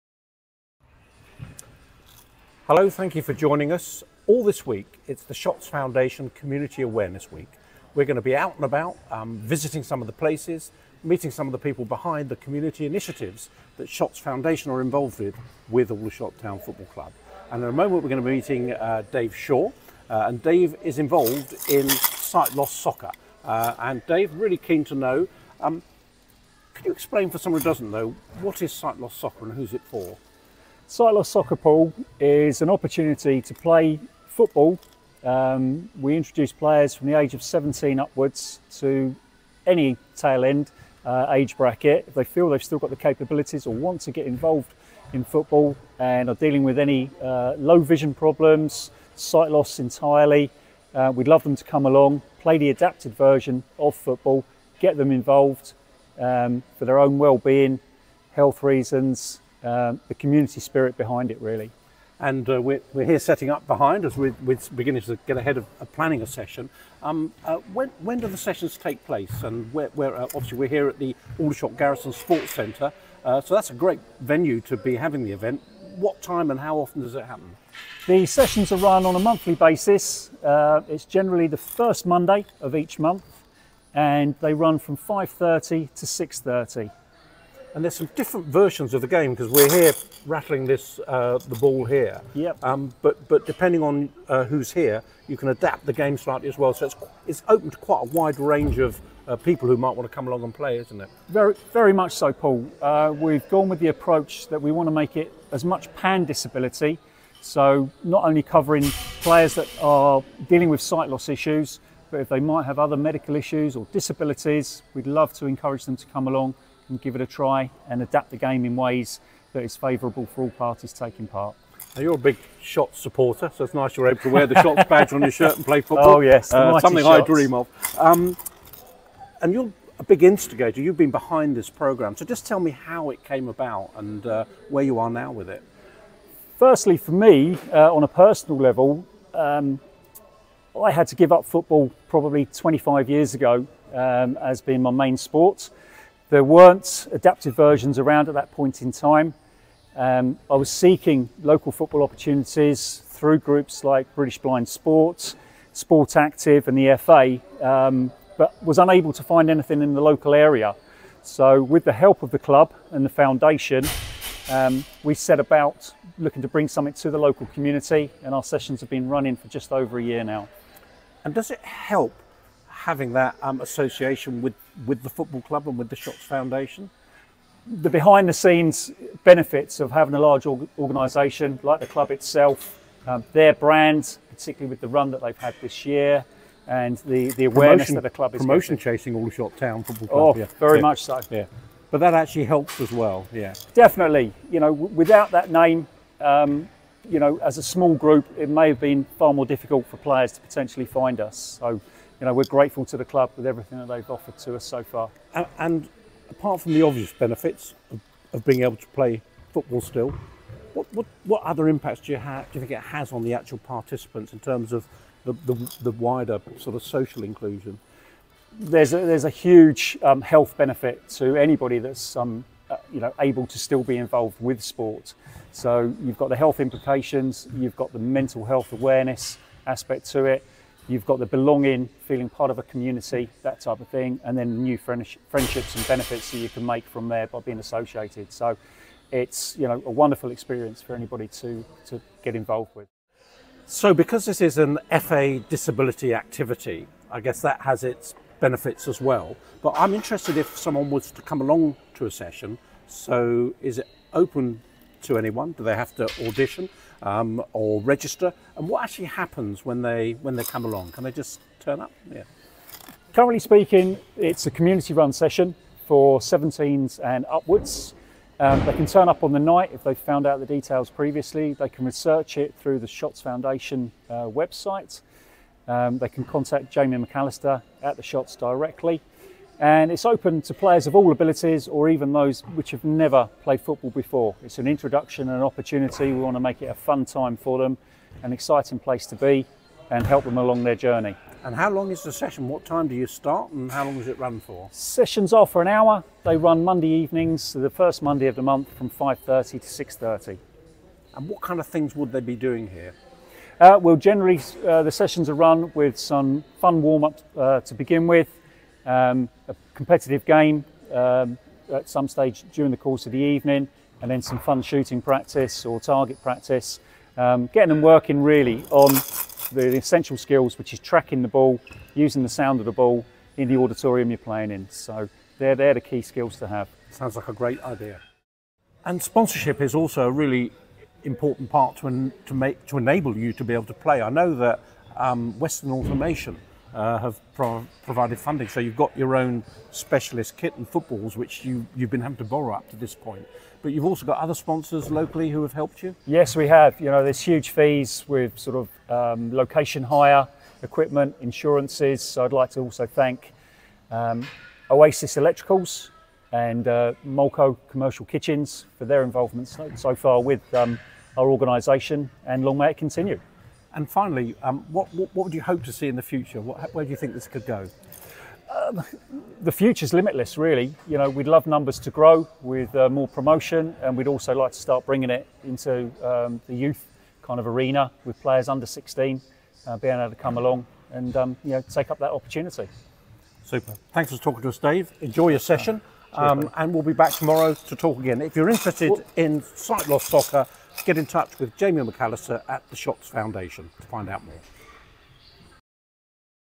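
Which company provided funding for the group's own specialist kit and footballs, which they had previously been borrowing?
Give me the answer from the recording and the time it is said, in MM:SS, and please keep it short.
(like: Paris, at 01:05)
Western Automation, at 05:35.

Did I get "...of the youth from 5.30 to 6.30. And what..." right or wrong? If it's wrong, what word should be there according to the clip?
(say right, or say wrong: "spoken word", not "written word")
wrong: "month", not "youth".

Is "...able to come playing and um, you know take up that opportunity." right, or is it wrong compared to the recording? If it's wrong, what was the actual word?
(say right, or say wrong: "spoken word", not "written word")
wrong: "along", not "playing".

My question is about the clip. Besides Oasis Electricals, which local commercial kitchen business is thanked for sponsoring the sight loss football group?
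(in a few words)
Molco Commercial Kitchens.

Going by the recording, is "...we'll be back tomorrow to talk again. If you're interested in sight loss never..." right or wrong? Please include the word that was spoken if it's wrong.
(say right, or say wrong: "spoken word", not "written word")
wrong: "soccer", not "never".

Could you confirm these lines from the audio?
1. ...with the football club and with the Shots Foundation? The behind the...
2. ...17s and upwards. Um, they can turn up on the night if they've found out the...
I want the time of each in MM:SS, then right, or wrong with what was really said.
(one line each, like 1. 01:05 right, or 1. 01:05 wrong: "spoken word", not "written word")
1. 02:54 right
2. 04:26 right.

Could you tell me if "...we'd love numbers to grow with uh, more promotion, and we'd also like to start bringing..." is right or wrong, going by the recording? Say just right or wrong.
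right.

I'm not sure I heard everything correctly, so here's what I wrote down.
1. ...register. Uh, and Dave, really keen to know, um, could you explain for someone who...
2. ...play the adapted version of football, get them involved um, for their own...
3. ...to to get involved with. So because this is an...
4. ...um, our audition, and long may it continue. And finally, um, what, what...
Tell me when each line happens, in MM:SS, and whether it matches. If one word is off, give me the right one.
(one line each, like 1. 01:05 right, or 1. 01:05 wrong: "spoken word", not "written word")
1. 00:22 wrong: "soccer", not "register"
2. 00:52 right
3. 04:01 right
4. 06:00 wrong: "organisation", not "audition".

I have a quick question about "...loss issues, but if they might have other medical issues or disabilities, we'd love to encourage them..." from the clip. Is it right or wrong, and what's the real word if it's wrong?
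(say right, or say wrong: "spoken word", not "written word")
right.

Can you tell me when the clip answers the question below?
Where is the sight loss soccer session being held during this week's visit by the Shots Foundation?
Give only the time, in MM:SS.
01:11.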